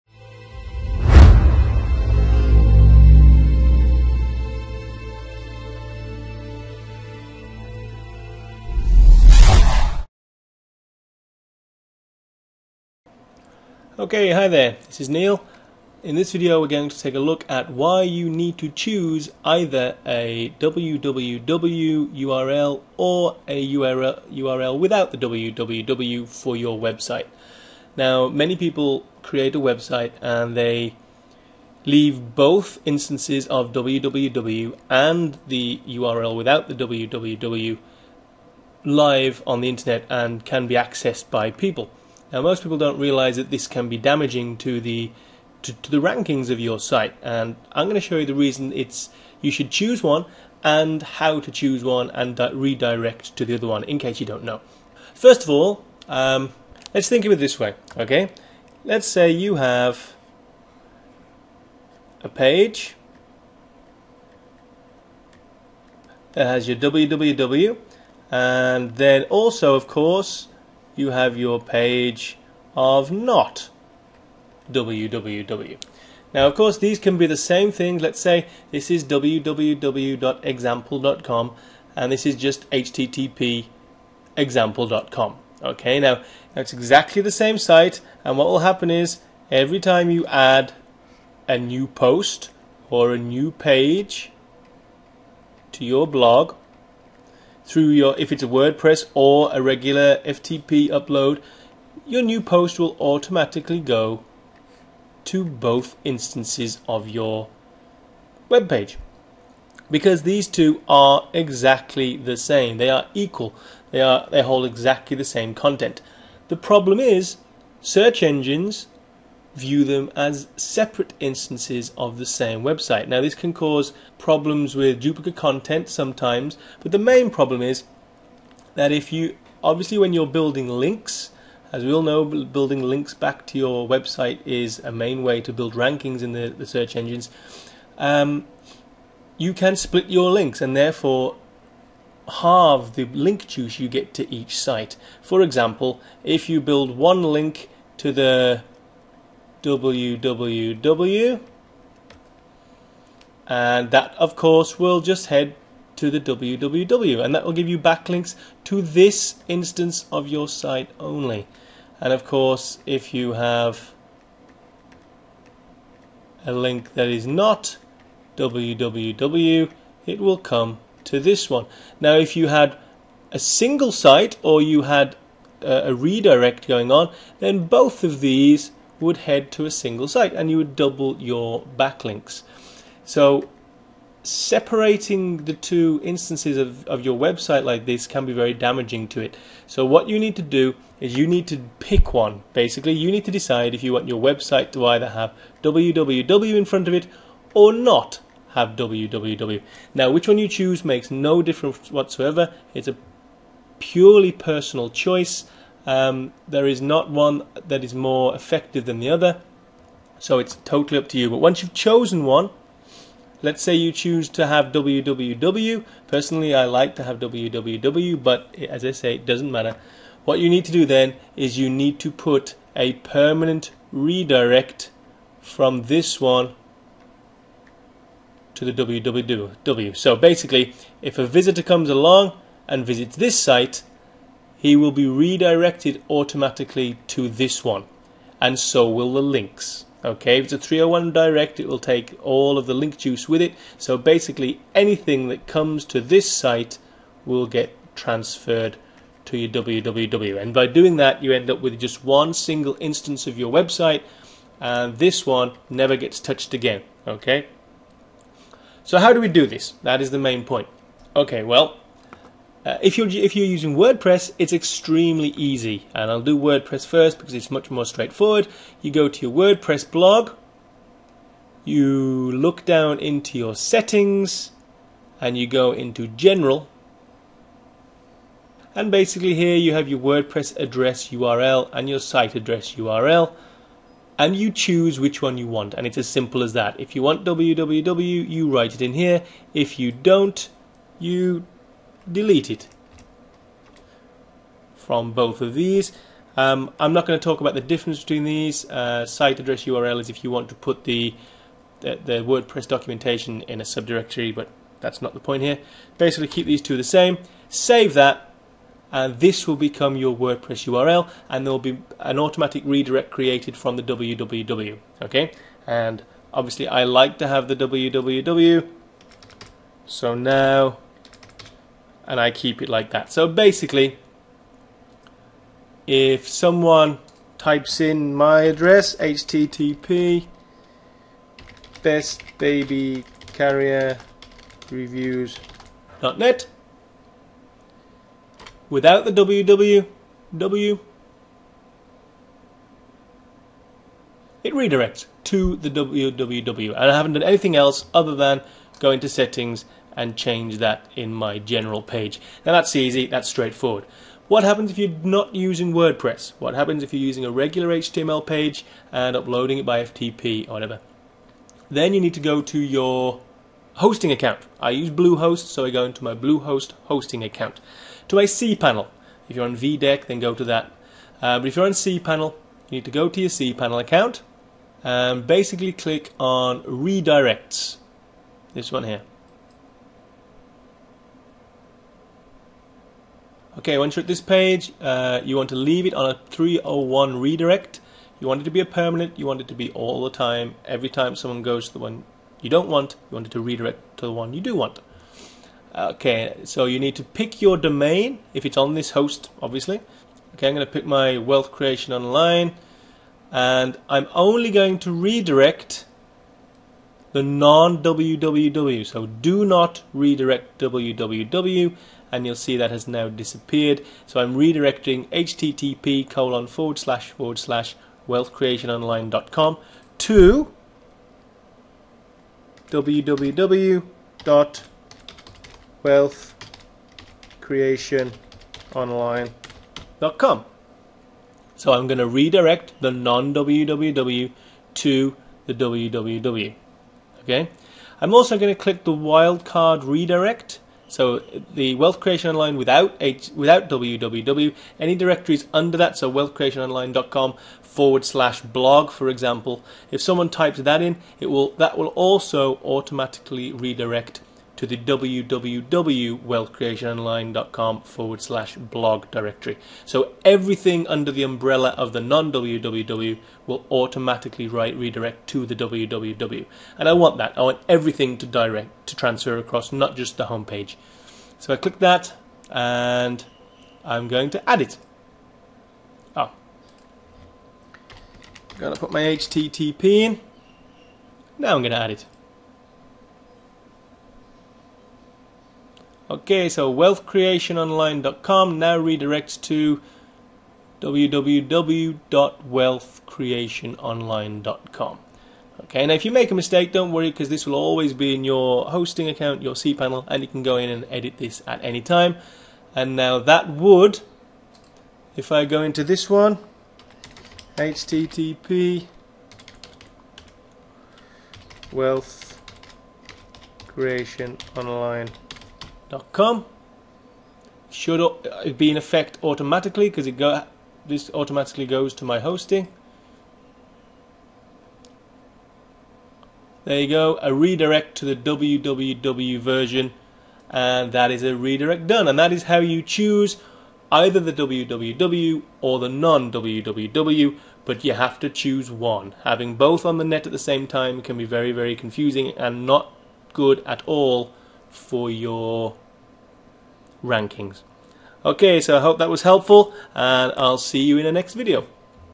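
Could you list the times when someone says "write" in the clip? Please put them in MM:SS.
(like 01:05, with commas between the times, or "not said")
04:48, 07:44.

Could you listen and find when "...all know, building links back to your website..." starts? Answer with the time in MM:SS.
02:11.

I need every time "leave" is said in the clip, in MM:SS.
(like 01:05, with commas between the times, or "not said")
00:31, 06:25.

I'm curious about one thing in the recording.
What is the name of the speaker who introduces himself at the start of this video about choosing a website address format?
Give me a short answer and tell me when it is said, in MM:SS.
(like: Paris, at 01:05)
Neil, at 00:15.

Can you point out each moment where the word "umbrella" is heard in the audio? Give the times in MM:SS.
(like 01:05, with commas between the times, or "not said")
07:41.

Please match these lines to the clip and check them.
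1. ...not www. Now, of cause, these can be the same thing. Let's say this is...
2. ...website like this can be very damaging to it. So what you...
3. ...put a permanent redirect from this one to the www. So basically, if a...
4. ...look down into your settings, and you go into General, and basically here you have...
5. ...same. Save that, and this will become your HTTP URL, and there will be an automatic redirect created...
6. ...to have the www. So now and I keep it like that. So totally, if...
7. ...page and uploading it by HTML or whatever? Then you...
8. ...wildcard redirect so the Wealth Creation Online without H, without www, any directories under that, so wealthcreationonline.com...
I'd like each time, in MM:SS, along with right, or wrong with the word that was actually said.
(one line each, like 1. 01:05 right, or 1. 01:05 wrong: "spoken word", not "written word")
1. 01:13 wrong: "course", not "cause"
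2. 03:07 right
3. 03:42 right
4. 04:32 right
5. 05:06 wrong: "WordPress", not "HTTP"
6. 05:17 wrong: "basically", not "totally"
7. 05:58 wrong: "FTP", not "HTML"
8. 07:18 right.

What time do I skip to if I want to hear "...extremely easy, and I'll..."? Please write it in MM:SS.
04:24.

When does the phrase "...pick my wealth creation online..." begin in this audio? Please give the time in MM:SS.
06:40.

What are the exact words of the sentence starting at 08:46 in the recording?
There you go, a redirect to the www version, and that is a redirect done.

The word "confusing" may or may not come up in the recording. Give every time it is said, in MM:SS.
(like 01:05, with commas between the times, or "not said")
09:01.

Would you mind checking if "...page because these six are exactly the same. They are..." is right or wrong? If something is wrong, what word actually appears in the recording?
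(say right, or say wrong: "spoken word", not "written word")
wrong: "two", not "six".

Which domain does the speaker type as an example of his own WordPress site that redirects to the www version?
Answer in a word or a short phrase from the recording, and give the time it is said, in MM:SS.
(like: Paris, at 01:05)
bestbabycarrierreviews.net, at 05:31.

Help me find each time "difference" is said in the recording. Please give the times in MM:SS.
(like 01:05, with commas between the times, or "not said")
03:21, 04:57.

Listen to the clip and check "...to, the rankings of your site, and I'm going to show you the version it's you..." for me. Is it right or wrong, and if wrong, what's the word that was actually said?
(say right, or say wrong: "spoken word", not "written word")
wrong: "reason", not "version".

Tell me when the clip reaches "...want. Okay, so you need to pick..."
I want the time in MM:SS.
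06:34.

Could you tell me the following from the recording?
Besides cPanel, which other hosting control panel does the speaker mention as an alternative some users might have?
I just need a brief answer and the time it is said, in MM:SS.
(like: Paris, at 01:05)
VDeck, at 06:09.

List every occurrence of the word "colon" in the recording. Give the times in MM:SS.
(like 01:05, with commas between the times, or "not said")
06:56.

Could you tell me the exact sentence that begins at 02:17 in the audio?
Um, you can split your links and therefore halve the link juice you get to each site.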